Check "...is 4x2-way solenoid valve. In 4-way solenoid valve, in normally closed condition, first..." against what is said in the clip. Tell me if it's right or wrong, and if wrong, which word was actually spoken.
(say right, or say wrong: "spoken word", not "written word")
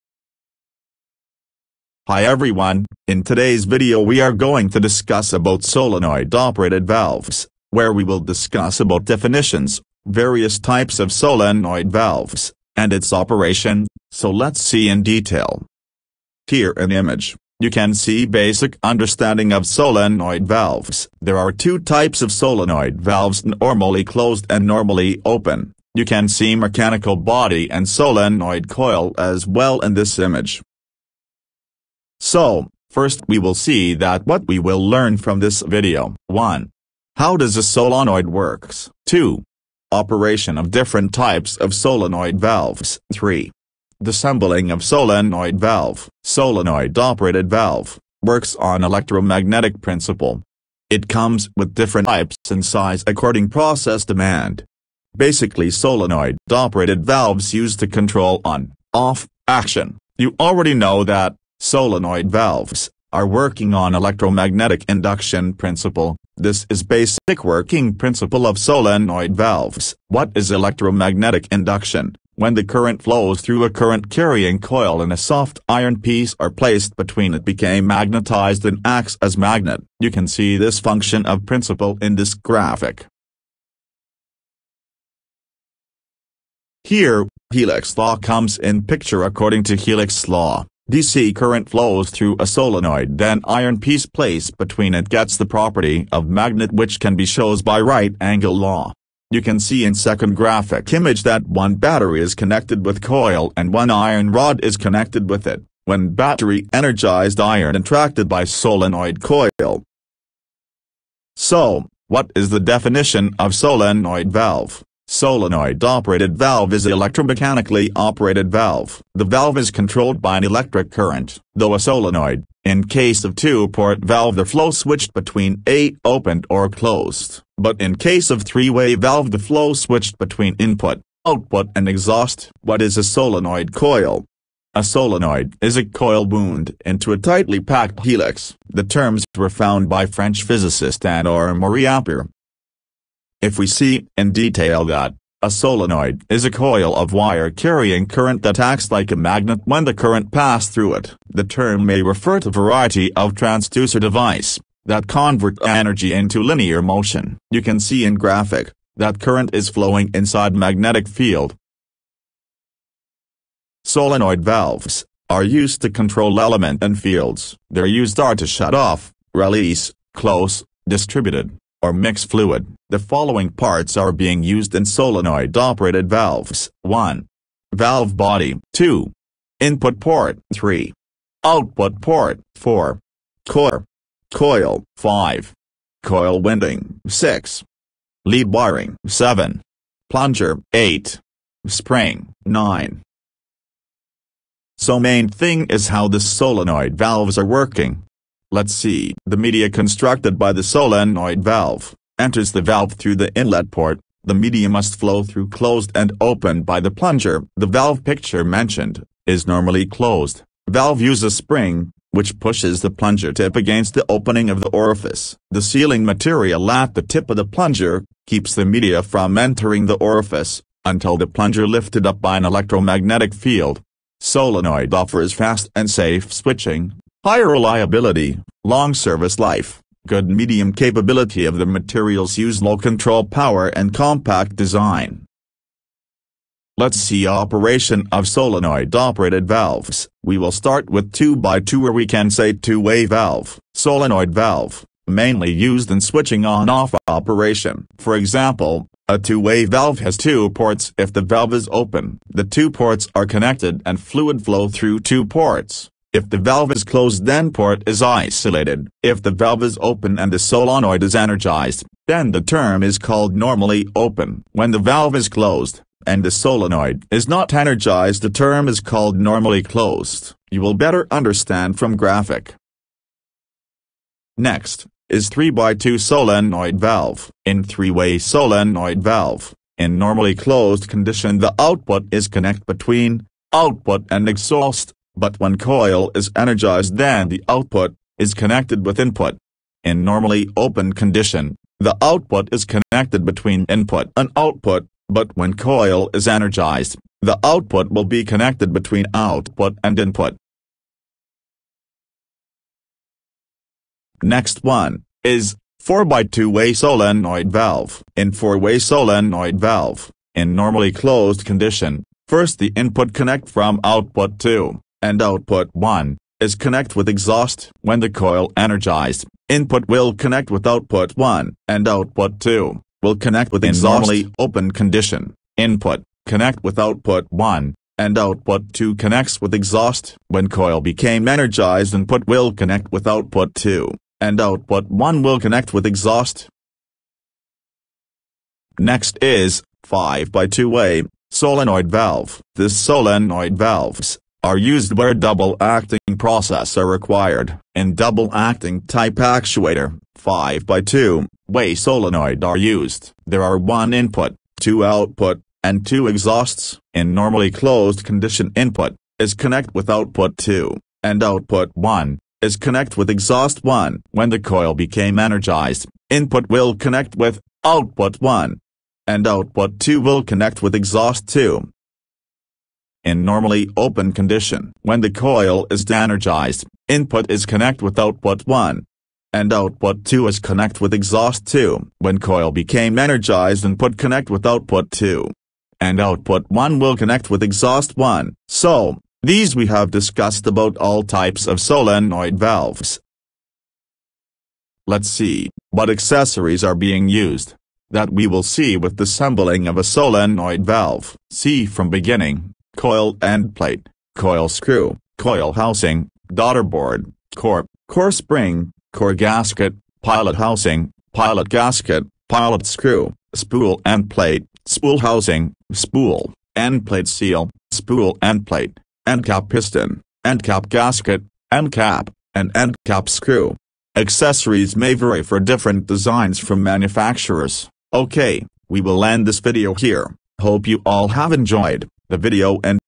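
right.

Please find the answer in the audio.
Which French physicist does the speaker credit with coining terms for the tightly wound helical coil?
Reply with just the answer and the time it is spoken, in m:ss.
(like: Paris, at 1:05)
André Marie Ampere, at 2:21.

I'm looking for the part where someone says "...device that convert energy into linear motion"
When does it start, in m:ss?
2:33.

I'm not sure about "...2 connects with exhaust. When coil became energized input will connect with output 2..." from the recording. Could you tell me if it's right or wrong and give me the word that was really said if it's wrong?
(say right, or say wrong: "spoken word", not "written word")
right.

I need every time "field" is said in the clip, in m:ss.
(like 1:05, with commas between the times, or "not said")
2:41, 2:46, 3:43.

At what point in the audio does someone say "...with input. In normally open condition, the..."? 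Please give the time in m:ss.
4:48.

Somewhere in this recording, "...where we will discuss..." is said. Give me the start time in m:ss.
0:07.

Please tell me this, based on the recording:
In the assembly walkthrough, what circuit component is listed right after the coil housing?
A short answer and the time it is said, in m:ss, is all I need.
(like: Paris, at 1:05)
Daughter board, at 6:46.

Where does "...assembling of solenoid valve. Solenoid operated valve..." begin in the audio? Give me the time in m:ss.
0:44.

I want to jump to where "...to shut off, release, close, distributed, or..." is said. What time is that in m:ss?
2:48.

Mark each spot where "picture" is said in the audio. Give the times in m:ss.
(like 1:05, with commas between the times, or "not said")
1:28, 3:28.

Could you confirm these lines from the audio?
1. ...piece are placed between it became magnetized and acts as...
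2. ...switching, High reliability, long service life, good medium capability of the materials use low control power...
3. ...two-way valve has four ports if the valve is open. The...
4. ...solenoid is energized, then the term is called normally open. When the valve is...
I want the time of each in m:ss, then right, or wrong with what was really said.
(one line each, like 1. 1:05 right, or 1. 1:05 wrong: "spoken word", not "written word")
1. 1:16 right
2. 3:46 right
3. 4:09 wrong: "two", not "four"
4. 4:20 right.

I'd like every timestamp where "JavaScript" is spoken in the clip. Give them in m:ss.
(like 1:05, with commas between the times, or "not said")
not said.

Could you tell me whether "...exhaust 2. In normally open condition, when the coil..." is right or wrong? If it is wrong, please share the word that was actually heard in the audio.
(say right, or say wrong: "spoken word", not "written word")
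right.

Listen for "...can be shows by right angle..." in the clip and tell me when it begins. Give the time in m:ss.
1:36.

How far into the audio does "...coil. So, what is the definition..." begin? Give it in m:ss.
1:49.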